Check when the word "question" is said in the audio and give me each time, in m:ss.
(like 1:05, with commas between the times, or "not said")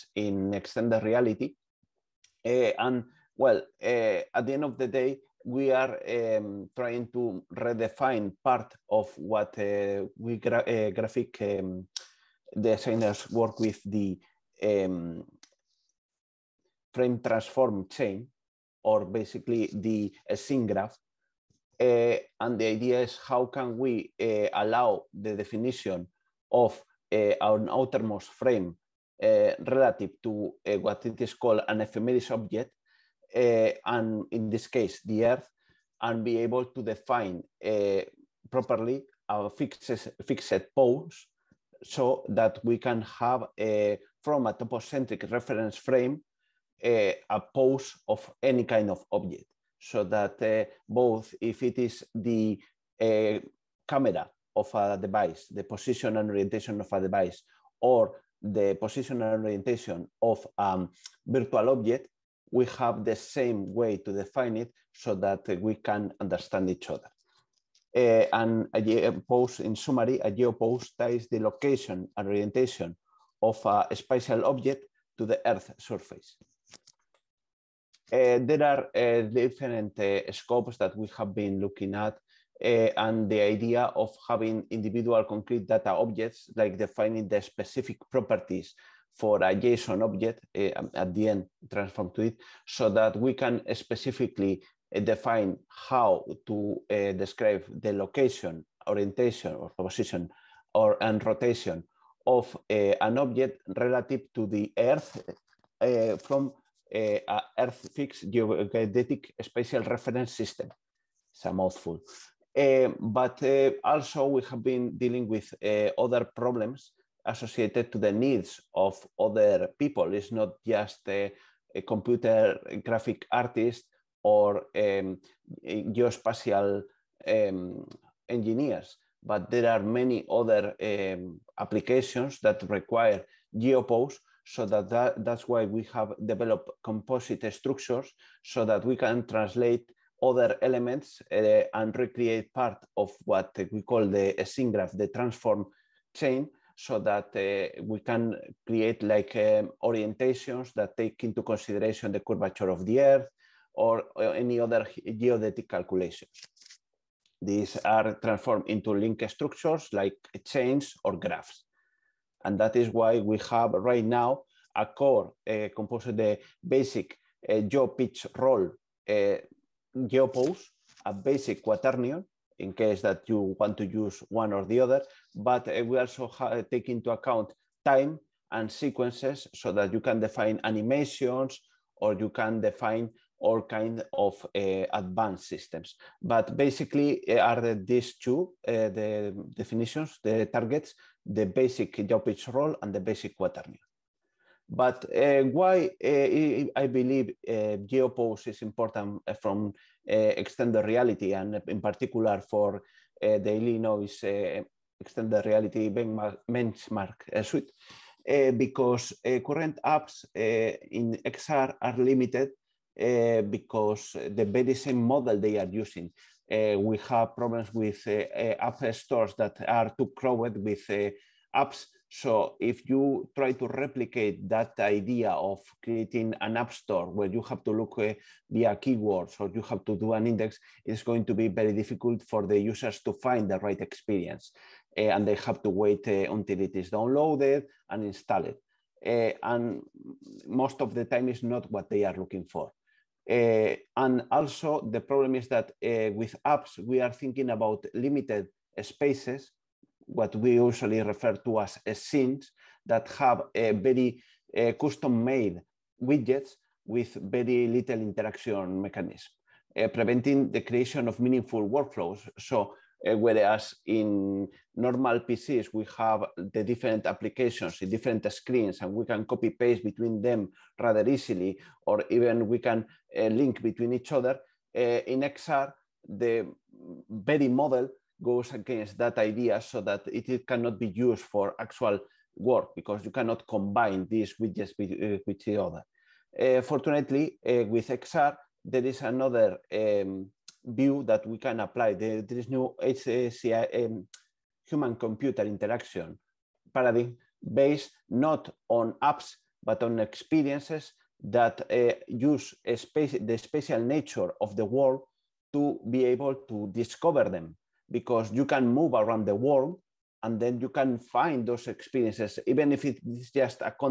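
not said.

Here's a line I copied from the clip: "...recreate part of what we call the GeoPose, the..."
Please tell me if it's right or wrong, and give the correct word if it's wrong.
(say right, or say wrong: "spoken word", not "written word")
wrong: "SYNGRAPH", not "GeoPose".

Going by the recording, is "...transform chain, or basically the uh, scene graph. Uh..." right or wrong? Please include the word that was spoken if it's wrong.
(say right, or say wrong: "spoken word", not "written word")
right.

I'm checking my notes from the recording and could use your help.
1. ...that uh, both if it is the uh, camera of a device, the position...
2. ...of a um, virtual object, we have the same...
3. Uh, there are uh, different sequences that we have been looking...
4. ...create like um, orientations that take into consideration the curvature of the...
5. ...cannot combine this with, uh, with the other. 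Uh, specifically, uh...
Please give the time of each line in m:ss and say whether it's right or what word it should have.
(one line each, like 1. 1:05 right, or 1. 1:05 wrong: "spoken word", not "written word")
1. 0:50 right
2. 1:00 right
3. 1:18 wrong: "scopes", not "sequences"
4. 2:28 right
5. 4:43 wrong: "fortunately", not "specifically".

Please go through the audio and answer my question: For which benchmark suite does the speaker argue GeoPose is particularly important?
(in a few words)
Illinois extended reality benchmark suite.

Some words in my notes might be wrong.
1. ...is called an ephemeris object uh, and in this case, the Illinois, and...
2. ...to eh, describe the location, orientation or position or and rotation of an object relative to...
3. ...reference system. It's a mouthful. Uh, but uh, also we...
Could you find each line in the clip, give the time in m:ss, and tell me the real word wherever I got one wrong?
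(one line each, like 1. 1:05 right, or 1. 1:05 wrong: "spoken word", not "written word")
1. 0:31 wrong: "Earth", not "Illinois"
2. 1:36 right
3. 1:49 right.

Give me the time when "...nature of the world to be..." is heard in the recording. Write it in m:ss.
5:03.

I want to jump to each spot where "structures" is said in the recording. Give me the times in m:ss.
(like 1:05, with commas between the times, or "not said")
2:17, 2:39.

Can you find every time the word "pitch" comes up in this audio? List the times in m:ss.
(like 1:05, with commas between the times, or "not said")
2:47, 3:12.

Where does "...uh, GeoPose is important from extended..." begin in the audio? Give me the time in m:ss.
3:17.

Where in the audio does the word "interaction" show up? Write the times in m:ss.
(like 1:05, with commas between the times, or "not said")
4:18, 4:55.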